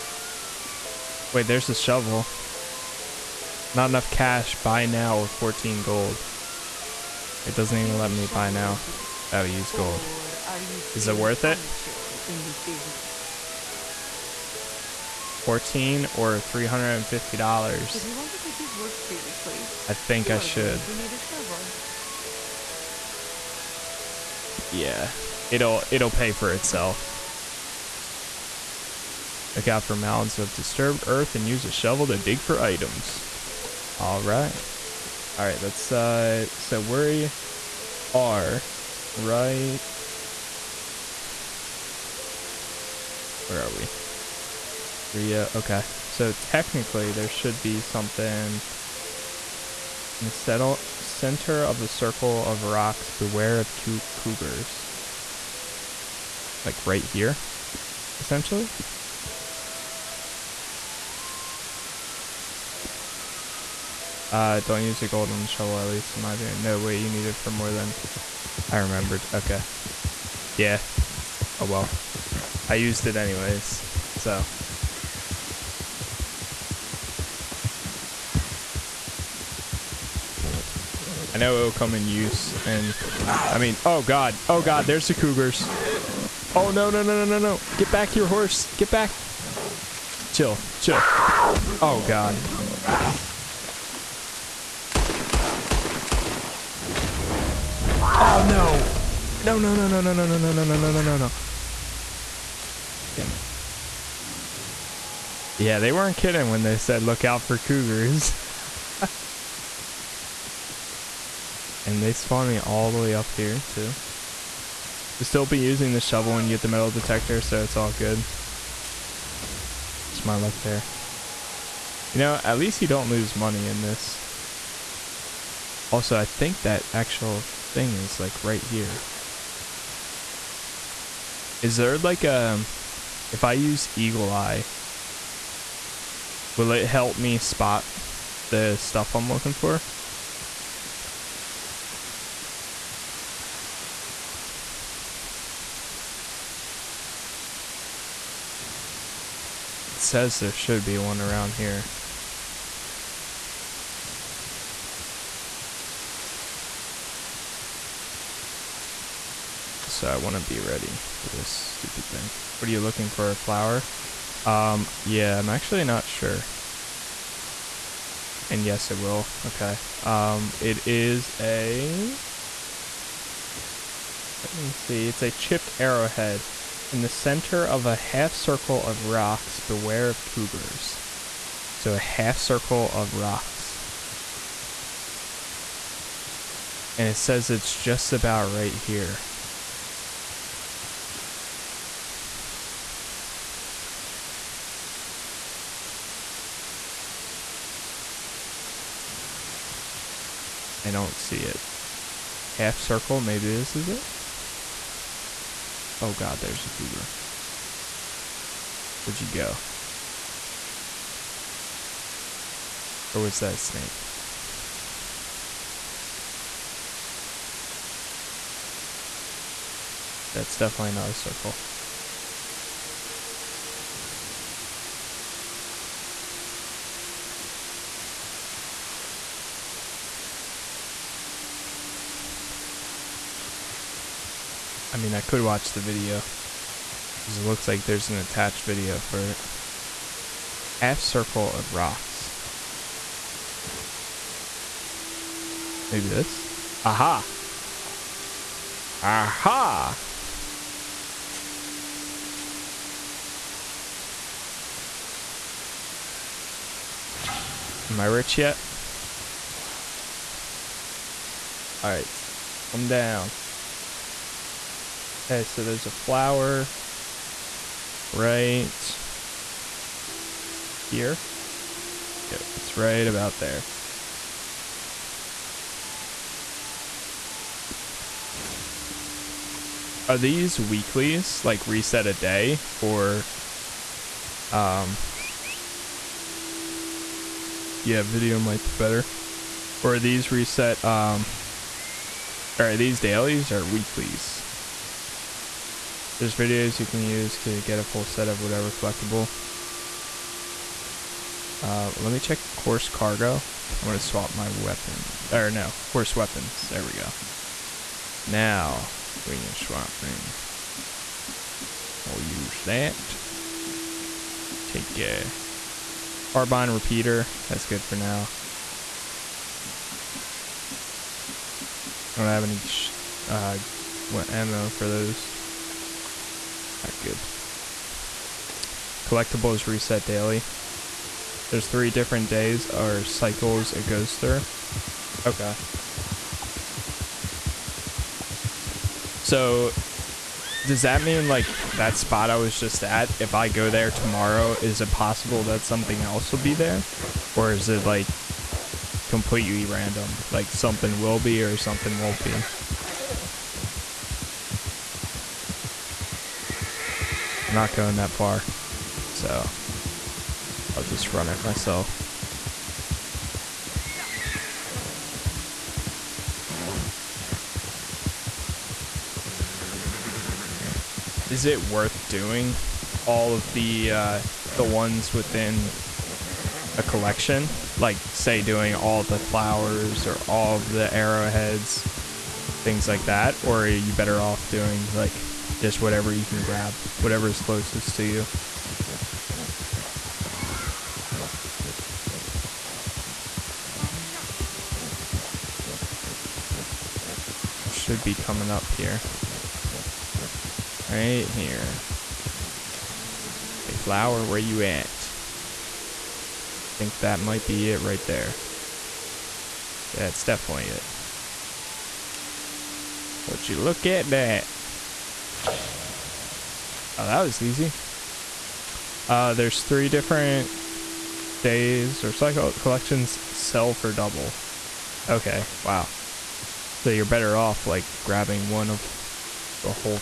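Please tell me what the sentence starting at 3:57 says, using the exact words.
Because it looks like there's an attached video for it.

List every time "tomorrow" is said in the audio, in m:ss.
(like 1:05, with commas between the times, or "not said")
5:43.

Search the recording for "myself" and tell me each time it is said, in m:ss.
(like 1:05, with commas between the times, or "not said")
6:01.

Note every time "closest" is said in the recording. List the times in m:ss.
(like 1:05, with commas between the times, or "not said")
6:27.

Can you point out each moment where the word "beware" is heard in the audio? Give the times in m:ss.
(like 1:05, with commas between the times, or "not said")
0:53, 2:59.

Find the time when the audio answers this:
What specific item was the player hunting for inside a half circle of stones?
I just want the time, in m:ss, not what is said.
2:55.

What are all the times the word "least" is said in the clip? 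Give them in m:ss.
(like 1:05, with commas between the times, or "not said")
1:05, 2:02.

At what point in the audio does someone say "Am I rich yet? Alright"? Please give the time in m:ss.
4:17.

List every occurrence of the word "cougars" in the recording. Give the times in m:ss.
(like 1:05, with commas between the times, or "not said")
0:54, 1:25, 1:47, 3:00, 3:26.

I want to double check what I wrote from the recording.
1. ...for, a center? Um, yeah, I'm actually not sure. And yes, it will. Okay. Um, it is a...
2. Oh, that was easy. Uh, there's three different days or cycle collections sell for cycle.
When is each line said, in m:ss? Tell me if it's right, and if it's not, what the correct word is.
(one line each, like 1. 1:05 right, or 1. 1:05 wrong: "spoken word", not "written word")
1. 2:43 wrong: "flower", not "center"
2. 6:56 wrong: "double", not "cycle".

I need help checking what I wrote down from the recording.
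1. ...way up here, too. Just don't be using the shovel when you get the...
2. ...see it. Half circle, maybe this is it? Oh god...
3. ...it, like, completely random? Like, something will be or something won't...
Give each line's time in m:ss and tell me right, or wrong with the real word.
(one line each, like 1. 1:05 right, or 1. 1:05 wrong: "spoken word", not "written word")
1. 1:53 right
2. 3:21 right
3. 5:47 right.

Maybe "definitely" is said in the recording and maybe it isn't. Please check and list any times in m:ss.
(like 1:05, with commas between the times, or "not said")
3:40, 6:50.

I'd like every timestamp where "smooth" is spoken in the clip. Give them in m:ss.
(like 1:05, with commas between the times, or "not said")
not said.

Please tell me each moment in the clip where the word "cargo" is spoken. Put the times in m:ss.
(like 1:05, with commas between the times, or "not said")
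5:02.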